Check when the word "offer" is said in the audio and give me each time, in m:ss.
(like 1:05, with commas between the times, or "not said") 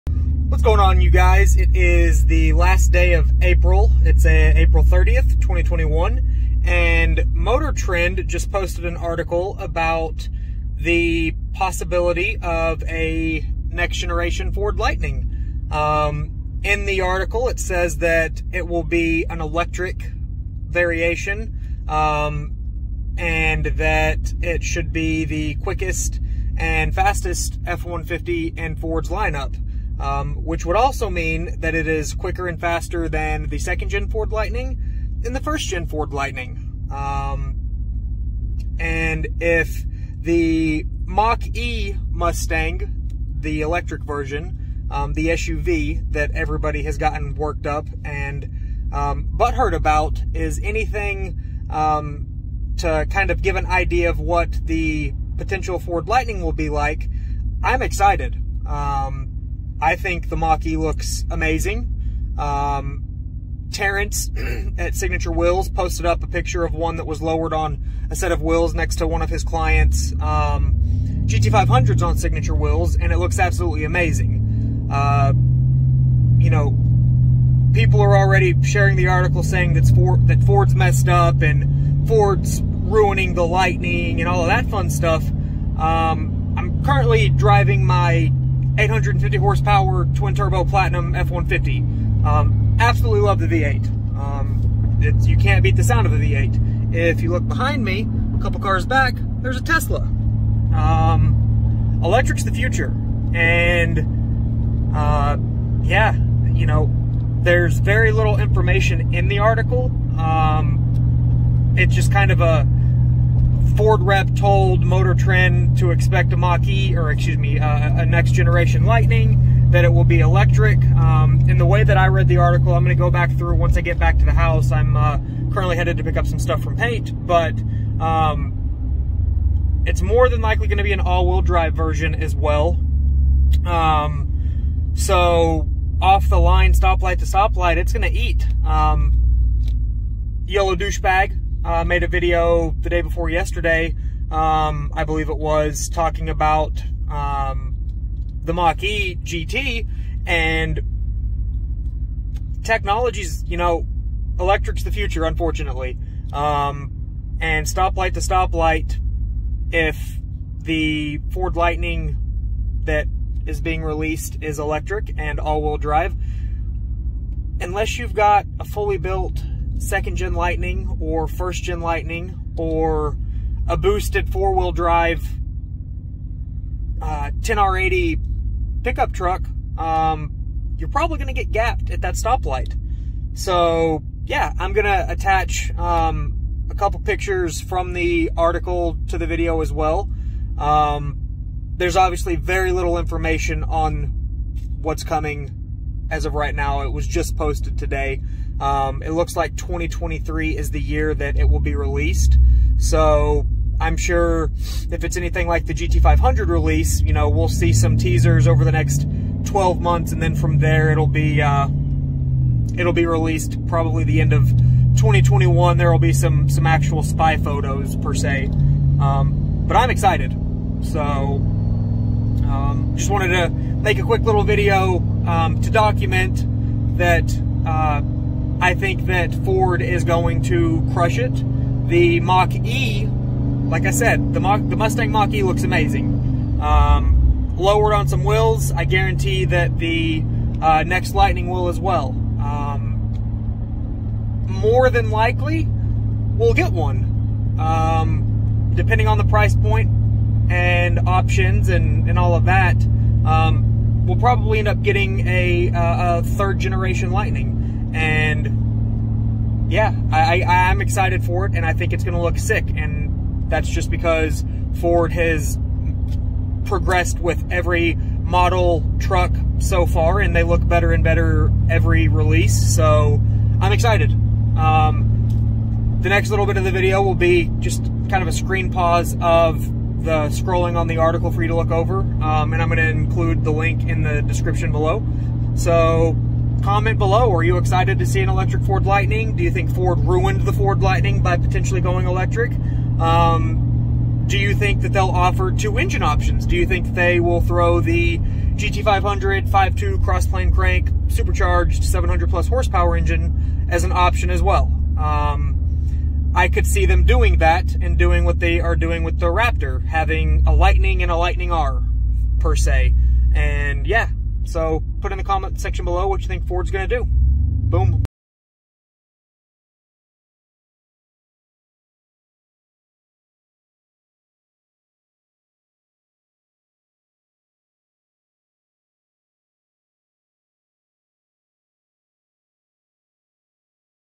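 4:55.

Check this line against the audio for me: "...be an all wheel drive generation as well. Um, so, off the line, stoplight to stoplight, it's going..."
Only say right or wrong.
wrong.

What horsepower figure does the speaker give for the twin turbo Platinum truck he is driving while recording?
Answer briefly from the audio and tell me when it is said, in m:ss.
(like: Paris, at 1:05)
850, at 1:28.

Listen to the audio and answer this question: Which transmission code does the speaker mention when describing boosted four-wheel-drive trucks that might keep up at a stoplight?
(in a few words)
10R80.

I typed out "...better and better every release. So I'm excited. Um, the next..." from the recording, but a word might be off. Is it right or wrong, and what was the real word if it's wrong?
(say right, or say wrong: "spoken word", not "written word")
right.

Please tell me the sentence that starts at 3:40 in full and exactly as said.
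So um, just wanted to make a quick little video um, to document that.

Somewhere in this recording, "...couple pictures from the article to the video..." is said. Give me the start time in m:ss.
3:06.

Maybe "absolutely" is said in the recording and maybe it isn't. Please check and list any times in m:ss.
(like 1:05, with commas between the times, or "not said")
1:13, 1:32.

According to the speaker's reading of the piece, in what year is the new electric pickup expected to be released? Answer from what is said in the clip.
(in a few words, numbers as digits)
2023.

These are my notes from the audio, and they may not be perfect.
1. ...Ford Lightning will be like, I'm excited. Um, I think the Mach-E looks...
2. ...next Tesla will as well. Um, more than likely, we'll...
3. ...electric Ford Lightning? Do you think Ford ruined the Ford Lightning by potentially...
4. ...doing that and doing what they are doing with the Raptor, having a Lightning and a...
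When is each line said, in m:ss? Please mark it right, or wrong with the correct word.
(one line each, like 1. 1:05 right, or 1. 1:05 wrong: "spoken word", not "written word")
1. 0:55 right
2. 4:00 wrong: "Lightning", not "Tesla"
3. 4:48 right
4. 5:07 right.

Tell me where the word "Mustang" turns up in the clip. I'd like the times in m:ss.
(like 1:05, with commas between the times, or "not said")
0:42, 3:54.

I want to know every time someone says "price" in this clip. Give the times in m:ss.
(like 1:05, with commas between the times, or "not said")
4:09.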